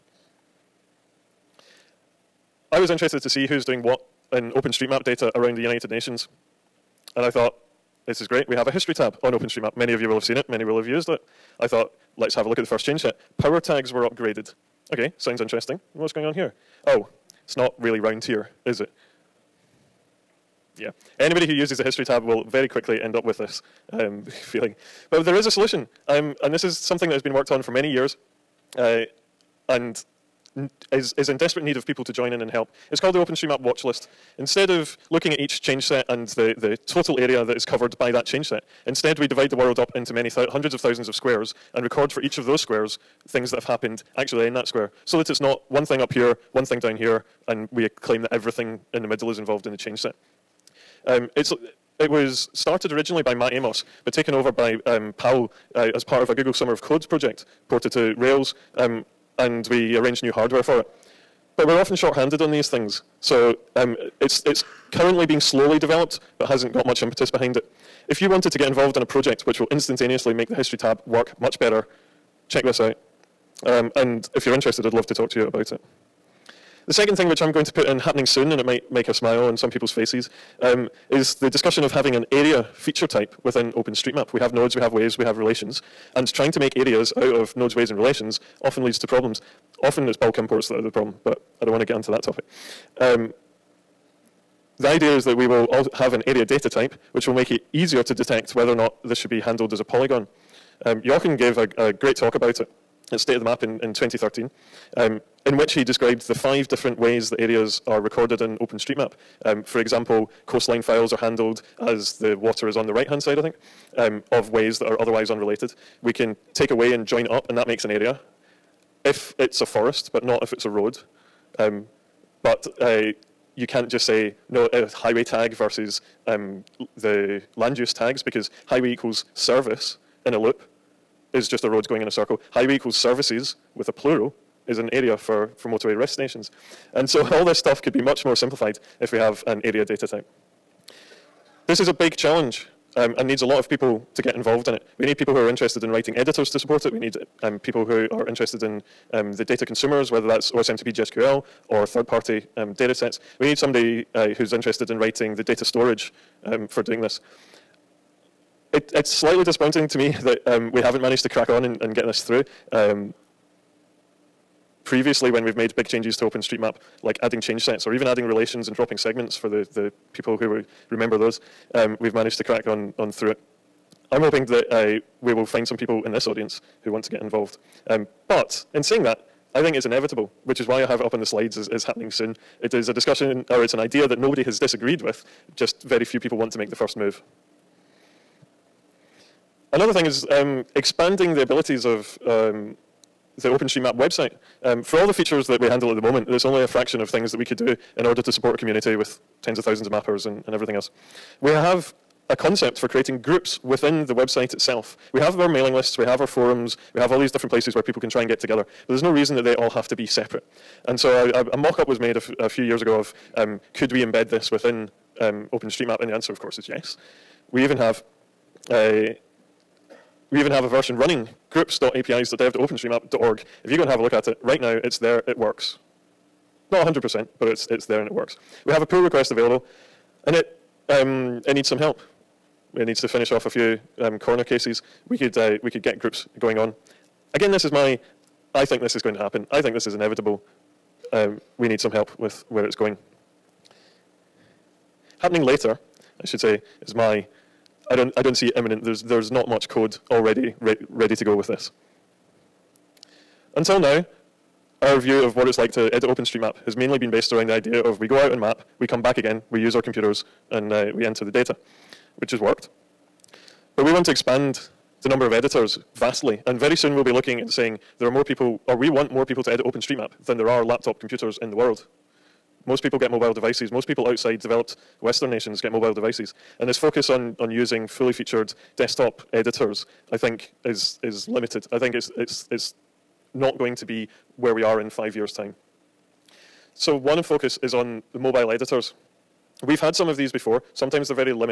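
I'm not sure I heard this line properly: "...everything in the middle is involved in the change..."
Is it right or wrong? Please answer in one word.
right.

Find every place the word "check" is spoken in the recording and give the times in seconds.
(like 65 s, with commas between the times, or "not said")
72 s.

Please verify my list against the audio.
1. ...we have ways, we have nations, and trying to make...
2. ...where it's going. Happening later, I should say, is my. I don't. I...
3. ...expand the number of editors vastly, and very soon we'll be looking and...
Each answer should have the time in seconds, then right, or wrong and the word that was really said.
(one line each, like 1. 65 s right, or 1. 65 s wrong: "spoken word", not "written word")
1. 84 s wrong: "relations", not "nations"
2. 242 s right
3. 264 s right.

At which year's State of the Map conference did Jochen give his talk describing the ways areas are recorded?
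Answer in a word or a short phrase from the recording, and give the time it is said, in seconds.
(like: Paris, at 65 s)
2013, at 103 s.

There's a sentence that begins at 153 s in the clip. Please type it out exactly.
We need somebody uh, who's interested in writing the data storage um, for doing this.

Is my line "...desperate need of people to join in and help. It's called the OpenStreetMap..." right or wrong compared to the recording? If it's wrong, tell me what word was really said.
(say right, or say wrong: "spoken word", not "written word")
right.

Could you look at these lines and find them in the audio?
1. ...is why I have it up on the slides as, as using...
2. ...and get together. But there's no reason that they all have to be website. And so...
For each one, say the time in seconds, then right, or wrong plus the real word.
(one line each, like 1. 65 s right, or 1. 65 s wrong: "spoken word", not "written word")
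1. 180 s wrong: "happening", not "using"
2. 208 s wrong: "separate", not "website".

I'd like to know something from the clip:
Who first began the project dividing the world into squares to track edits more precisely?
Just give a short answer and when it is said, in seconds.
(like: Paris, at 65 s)
Matt Amos, at 53 s.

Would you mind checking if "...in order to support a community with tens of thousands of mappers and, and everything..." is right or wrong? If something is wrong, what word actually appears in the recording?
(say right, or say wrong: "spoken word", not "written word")
right.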